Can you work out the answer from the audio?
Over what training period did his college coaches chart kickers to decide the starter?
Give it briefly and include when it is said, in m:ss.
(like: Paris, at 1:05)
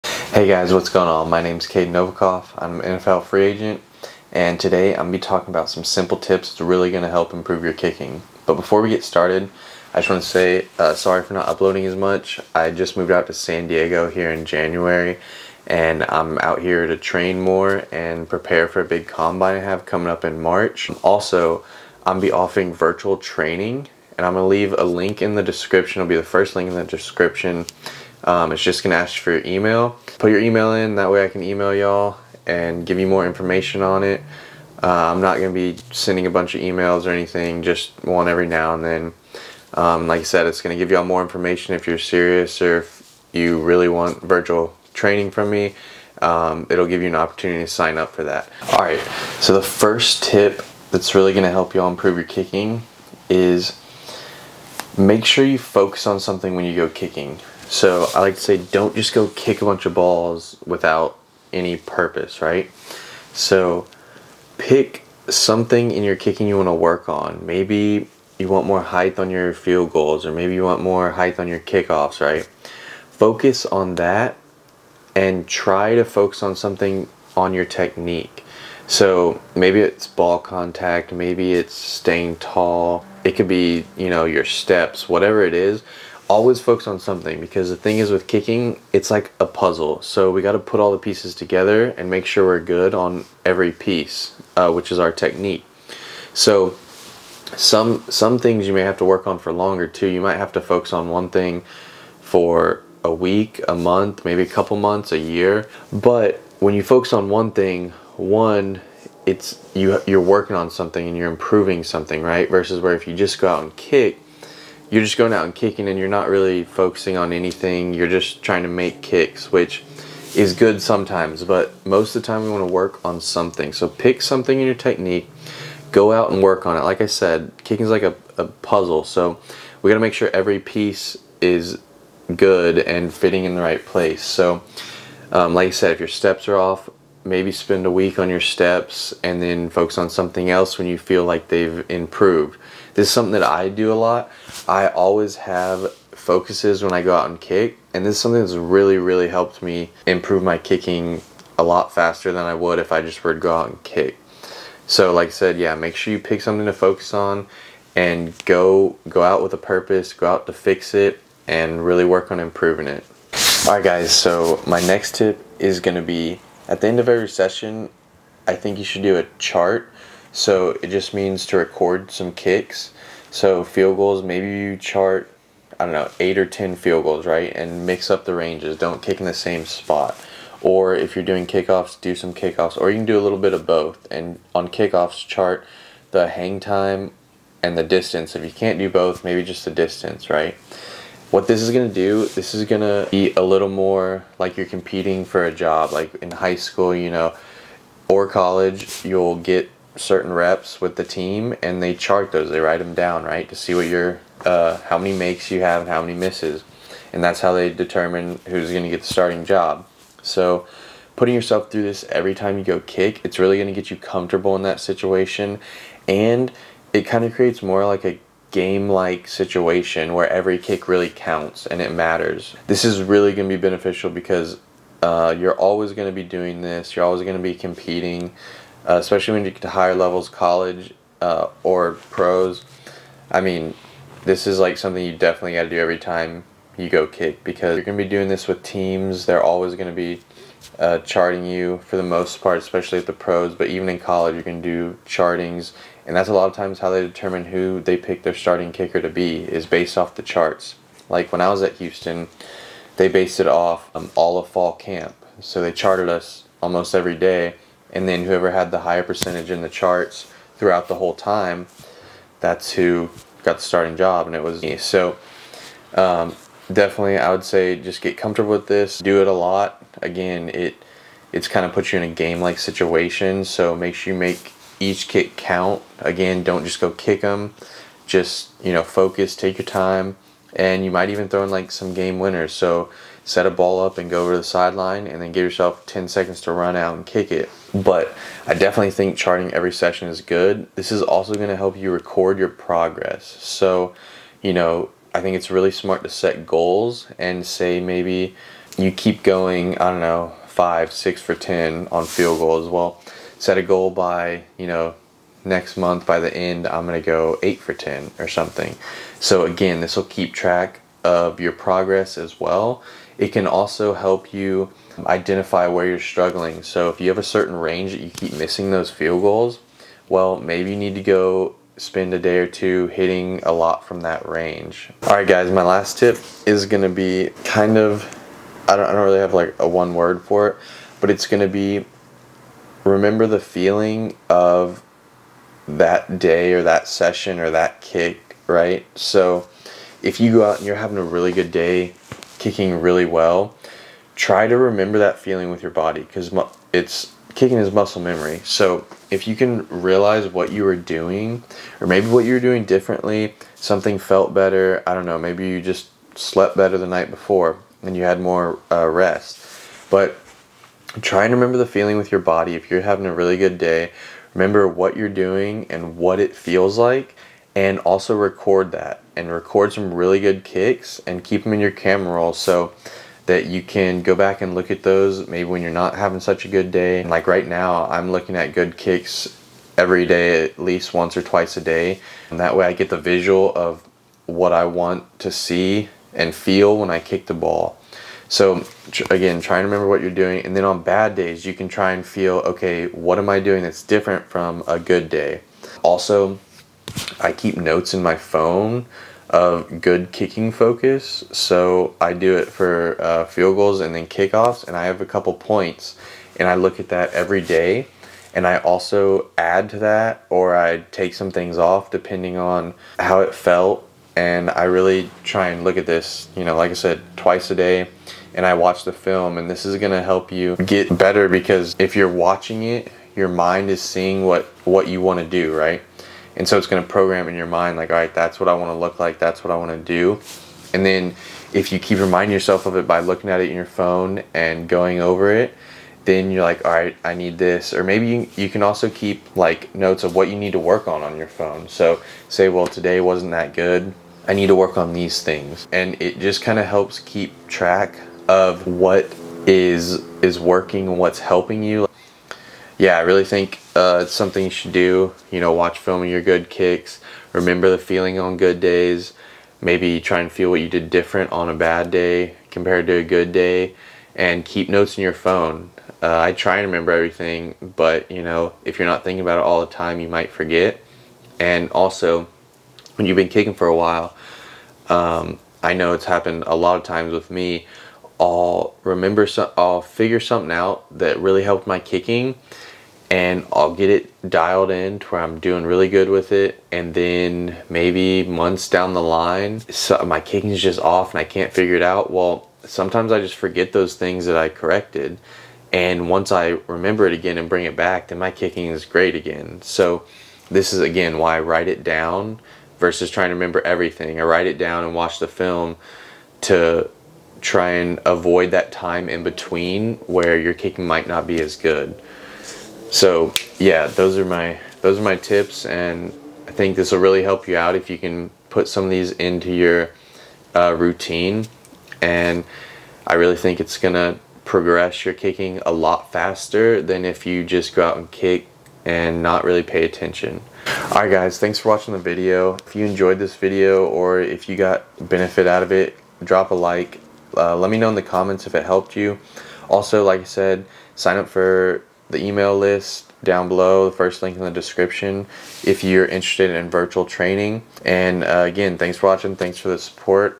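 Fall camp, at 4:14.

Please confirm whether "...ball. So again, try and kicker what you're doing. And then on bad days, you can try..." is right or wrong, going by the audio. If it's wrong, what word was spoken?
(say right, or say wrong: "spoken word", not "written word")
wrong: "remember", not "kicker".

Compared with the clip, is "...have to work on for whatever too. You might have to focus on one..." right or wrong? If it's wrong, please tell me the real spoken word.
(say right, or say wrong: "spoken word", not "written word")
wrong: "longer", not "whatever".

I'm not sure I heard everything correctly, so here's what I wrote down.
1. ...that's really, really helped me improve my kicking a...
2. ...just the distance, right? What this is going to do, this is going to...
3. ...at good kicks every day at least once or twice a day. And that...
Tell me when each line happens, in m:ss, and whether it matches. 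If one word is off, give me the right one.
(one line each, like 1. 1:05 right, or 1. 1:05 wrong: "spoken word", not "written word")
1. 2:28 right
2. 3:09 right
3. 6:18 right.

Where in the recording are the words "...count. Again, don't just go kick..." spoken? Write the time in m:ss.
4:35.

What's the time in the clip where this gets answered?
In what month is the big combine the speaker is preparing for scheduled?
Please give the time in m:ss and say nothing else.
0:20.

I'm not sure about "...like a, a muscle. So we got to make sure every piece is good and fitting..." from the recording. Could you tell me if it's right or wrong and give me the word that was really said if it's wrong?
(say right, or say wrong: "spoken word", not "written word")
wrong: "puzzle", not "muscle".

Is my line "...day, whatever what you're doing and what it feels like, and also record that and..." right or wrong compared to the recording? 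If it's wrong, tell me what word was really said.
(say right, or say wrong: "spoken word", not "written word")
wrong: "remember", not "whatever".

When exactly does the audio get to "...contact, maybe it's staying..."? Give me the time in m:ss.
1:20.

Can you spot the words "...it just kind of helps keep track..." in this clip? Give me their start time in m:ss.
7:26.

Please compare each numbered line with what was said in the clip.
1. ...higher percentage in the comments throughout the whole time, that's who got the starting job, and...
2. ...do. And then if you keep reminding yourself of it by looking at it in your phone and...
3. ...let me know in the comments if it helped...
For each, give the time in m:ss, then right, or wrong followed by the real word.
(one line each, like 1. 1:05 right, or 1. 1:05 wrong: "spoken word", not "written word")
1. 4:18 wrong: "charts", not "comments"
2. 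7:09 right
3. 8:57 right.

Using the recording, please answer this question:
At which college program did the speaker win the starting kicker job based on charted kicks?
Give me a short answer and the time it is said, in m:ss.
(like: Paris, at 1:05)
Houston, at 4:11.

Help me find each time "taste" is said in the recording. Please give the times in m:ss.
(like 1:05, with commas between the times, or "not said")
not said.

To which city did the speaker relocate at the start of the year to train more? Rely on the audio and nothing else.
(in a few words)
San Diego.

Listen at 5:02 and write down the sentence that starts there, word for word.
Well, set a goal by, you know, next month by the end, I'm going to go eight for 10 or something.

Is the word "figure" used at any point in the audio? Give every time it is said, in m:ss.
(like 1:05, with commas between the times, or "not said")
7:59, 8:11.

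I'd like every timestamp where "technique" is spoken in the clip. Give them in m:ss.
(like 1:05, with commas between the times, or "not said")
1:17, 1:35, 2:04.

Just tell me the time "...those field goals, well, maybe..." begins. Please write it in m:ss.
5:18.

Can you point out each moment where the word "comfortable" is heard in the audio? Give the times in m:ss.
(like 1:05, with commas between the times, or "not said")
3:33, 4:28.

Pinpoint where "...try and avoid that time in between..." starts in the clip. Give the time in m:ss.
8:27.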